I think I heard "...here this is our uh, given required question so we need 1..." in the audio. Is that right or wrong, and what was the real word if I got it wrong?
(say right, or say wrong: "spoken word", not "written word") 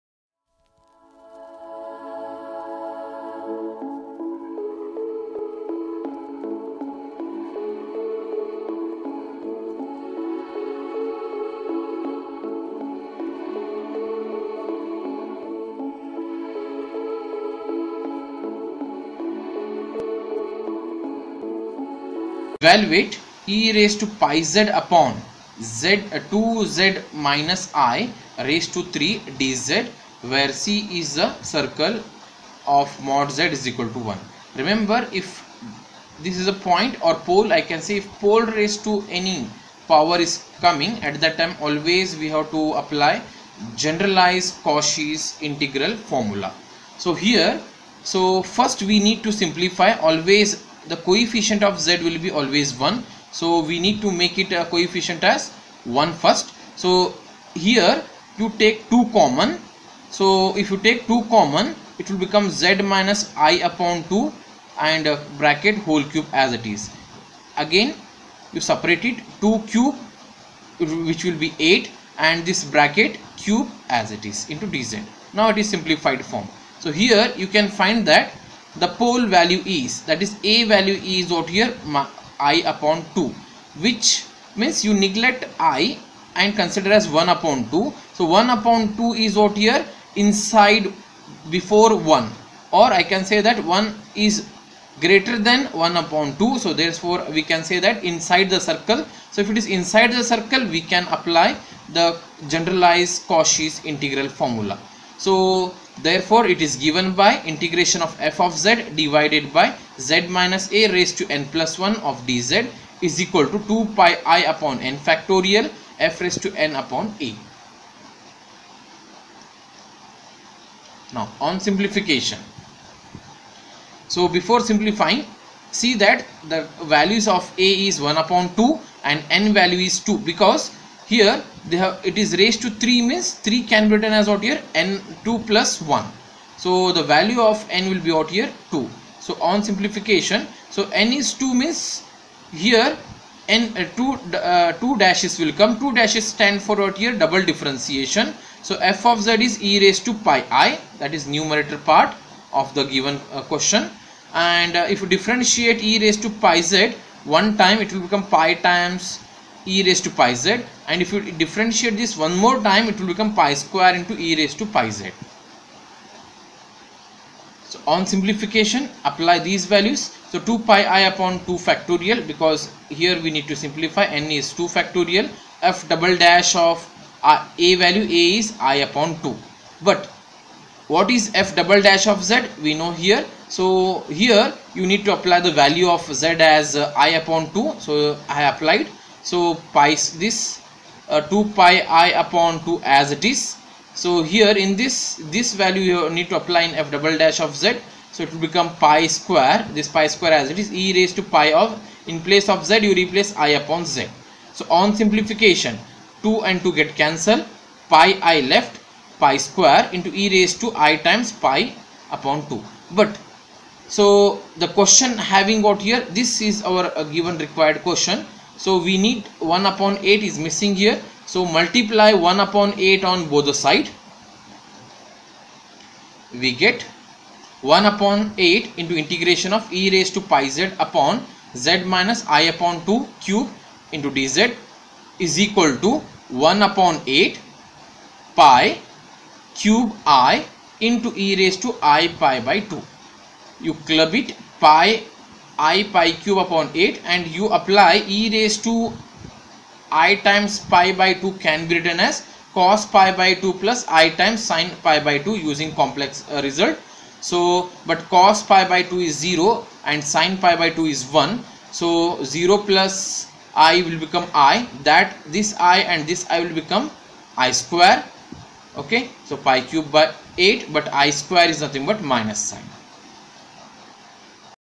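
right.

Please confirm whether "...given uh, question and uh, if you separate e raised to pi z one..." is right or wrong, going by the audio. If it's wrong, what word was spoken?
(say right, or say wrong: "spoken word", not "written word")
wrong: "differentiate", not "separate".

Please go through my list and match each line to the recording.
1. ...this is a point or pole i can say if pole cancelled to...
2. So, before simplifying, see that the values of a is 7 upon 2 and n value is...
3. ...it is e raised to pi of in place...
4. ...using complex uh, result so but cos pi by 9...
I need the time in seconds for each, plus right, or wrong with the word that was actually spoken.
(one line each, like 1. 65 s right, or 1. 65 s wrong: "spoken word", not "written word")
1. 36 s wrong: "raised", not "cancelled"
2. 124 s wrong: "1", not "7"
3. 200 s right
4. 255 s wrong: "2", not "9".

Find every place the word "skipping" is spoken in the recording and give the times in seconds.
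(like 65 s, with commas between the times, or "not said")
not said.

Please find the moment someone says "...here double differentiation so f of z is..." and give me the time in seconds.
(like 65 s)
147 s.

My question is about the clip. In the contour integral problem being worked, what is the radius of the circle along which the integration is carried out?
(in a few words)
1.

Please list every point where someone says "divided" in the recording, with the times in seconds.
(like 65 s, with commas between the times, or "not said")
108 s.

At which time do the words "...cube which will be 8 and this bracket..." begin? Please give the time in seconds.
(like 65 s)
69 s.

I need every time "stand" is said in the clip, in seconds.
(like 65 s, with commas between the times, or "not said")
146 s.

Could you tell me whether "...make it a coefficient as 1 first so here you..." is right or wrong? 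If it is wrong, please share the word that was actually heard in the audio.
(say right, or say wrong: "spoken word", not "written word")
right.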